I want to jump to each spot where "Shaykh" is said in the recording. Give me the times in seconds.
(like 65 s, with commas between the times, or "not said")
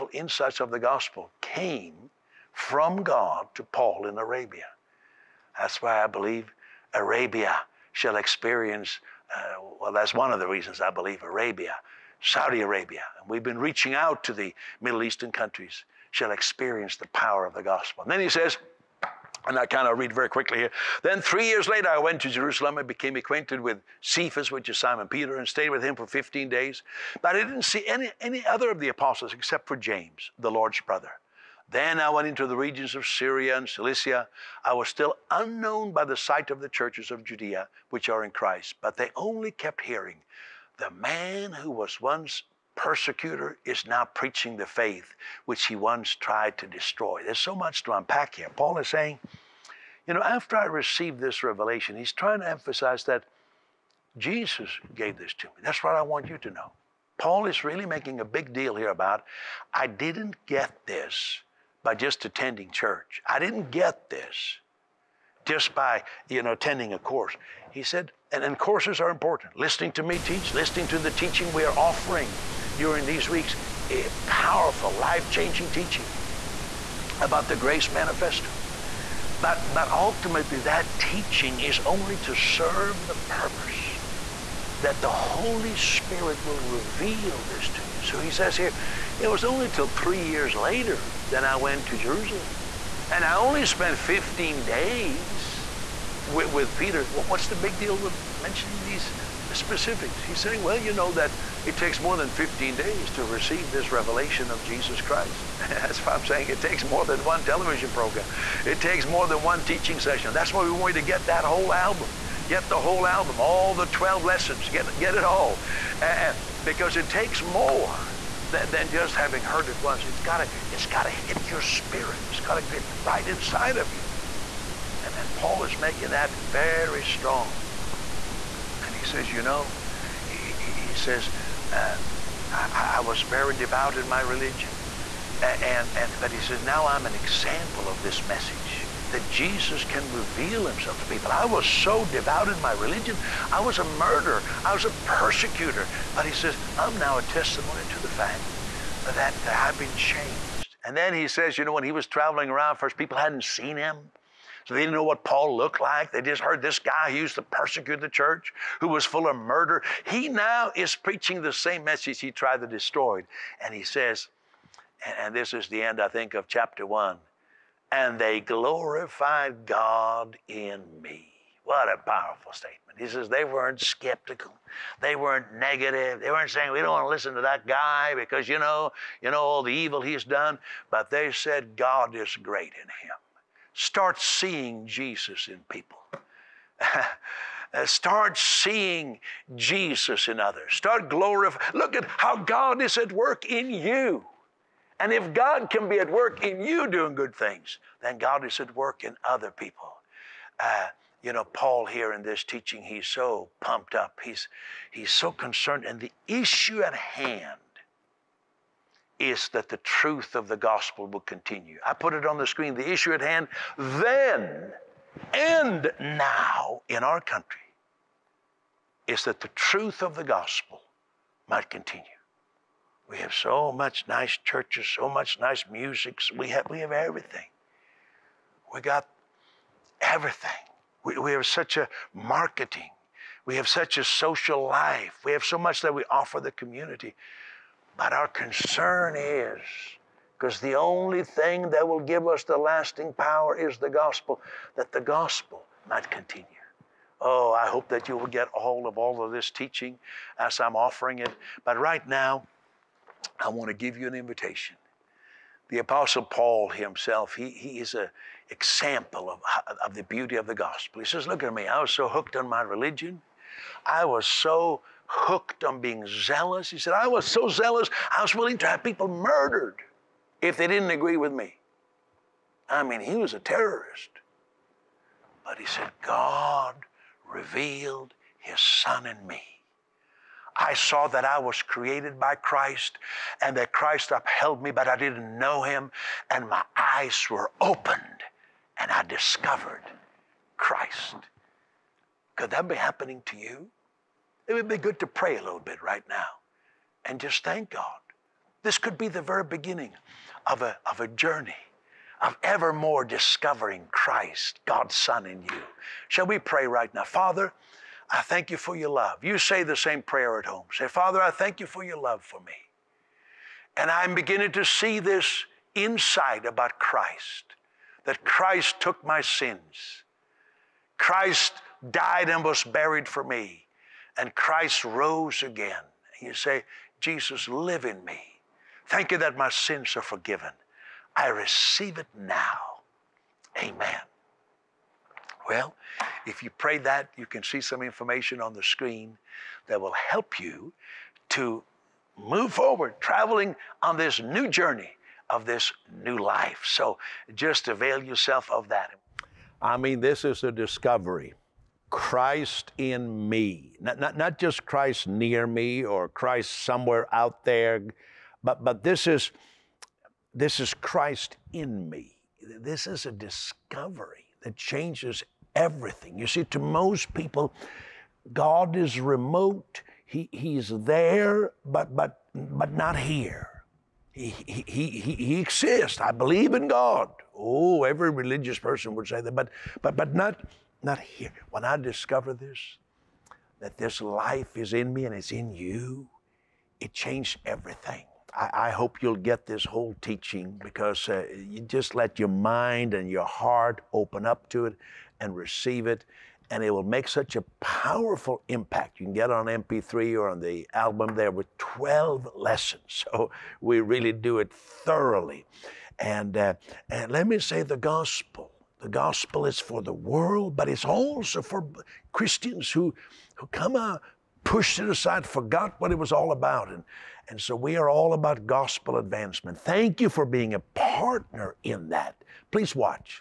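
not said.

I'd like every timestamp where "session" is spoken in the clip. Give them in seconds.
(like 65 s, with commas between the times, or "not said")
109 s.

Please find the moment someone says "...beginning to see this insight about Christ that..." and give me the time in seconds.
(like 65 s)
314 s.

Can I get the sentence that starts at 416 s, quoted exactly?
And, and so we are all about gospel advancement.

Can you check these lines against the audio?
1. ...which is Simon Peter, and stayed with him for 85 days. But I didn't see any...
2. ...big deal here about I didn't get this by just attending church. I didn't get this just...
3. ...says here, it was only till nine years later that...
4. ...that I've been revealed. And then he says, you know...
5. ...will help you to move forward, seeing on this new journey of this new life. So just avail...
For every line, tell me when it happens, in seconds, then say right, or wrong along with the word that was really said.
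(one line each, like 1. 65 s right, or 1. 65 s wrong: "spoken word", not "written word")
1. 24 s wrong: "15", not "85"
2. 58 s right
3. 88 s wrong: "three", not "nine"
4. 149 s wrong: "changed", not "revealed"
5. 339 s wrong: "traveling", not "seeing".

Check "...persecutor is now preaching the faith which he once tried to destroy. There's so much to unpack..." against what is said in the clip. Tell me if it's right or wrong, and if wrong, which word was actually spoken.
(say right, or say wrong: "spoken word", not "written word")
right.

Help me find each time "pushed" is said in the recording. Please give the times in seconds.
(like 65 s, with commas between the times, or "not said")
414 s.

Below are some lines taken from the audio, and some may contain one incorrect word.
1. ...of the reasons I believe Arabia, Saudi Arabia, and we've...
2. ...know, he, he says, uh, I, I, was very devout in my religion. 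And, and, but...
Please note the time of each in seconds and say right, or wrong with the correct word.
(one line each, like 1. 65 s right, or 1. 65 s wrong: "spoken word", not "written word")
1. 10 s right
2. 129 s right.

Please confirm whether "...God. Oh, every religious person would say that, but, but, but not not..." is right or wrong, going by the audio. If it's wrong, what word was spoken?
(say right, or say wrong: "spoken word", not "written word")
right.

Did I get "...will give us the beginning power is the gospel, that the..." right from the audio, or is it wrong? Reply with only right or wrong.
wrong.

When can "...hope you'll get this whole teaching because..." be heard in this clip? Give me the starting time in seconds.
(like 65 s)
388 s.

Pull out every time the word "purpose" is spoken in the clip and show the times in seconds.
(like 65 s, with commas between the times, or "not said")
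83 s.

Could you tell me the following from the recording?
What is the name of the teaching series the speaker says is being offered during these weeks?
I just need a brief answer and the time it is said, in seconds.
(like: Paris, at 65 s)
Grace Manifesto, at 77 s.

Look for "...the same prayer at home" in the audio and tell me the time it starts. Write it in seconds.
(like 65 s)
309 s.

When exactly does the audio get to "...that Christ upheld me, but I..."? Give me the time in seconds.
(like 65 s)
283 s.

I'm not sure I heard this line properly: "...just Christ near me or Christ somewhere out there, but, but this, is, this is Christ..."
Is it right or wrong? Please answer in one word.
right.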